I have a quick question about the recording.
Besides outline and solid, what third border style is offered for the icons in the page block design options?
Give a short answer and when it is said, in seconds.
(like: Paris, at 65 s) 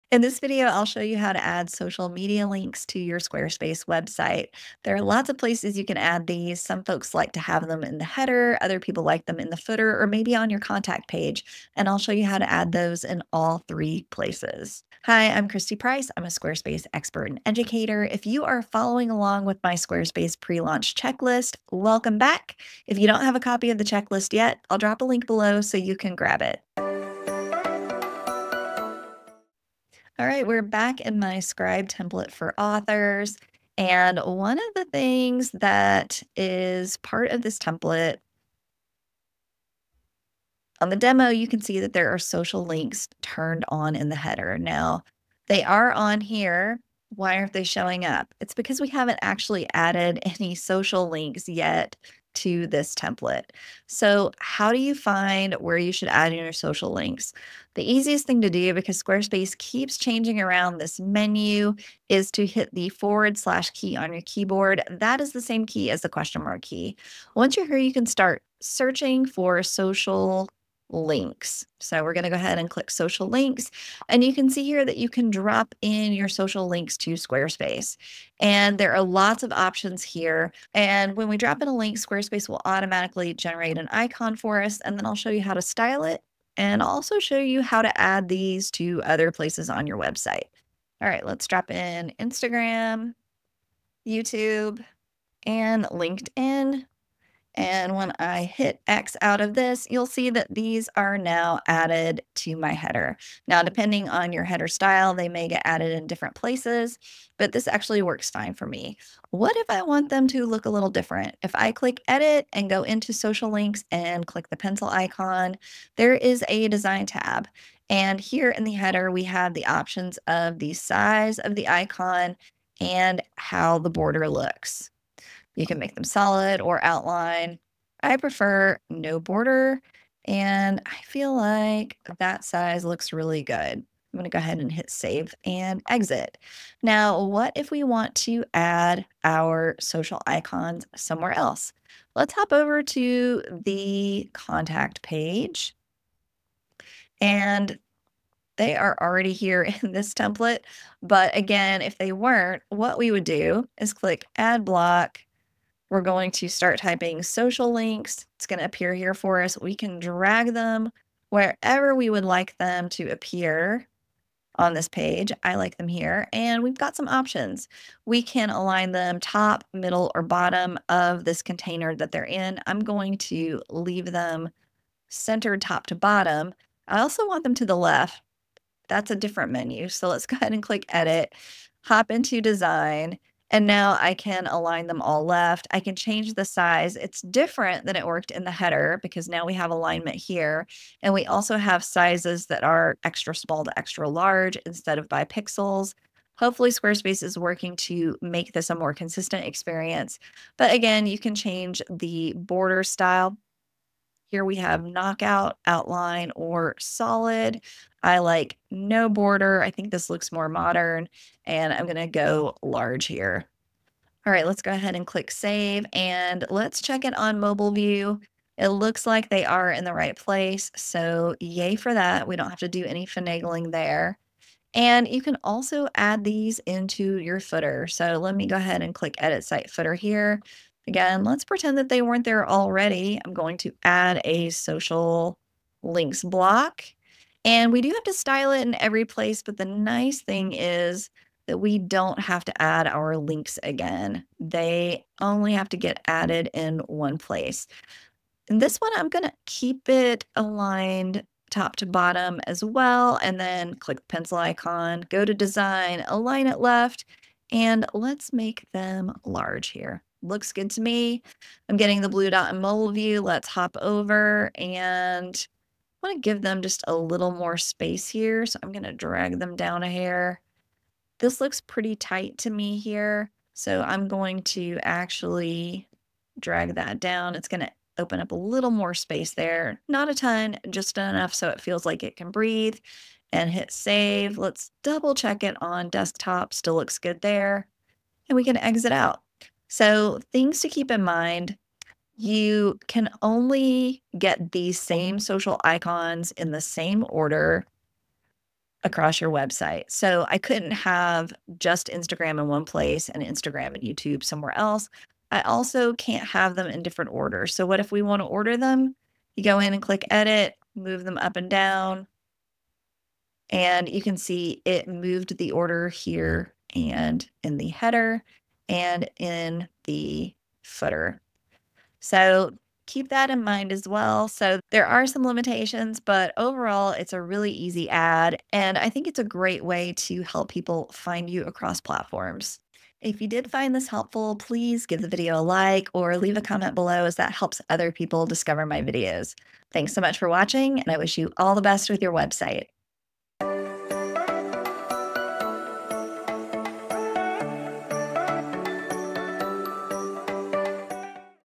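knockout, at 204 s.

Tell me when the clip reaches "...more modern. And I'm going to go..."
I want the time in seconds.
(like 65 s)
210 s.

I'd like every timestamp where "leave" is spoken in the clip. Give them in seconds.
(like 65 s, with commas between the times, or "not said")
173 s, 336 s.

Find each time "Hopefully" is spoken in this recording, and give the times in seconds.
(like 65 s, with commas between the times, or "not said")
196 s.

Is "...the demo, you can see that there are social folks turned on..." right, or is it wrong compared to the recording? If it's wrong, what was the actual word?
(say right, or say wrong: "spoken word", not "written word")
wrong: "links", not "folks".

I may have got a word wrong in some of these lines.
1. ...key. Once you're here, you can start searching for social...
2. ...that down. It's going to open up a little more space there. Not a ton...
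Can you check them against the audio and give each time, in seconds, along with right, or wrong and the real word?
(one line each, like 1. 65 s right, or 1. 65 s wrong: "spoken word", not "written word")
1. 66 s right
2. 276 s right.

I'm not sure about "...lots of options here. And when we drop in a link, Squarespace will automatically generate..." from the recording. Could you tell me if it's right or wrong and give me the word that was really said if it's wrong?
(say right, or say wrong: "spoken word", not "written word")
right.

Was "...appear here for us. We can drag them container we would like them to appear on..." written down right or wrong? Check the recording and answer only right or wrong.
wrong.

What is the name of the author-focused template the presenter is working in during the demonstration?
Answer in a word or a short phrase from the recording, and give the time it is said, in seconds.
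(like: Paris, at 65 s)
Scribe, at 31 s.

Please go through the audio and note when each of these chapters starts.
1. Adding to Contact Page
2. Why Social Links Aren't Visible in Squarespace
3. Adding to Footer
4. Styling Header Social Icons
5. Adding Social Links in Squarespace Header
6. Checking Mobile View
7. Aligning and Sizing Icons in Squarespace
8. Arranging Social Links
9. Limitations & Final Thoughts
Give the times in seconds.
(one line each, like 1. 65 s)
1. 138 s
2. 49 s
3. 227 s
4. 99 s
5. 62 s
6. 214 s
7. 163 s
8. 290 s
9. 324 s.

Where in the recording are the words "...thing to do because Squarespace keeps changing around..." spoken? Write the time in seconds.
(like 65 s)
58 s.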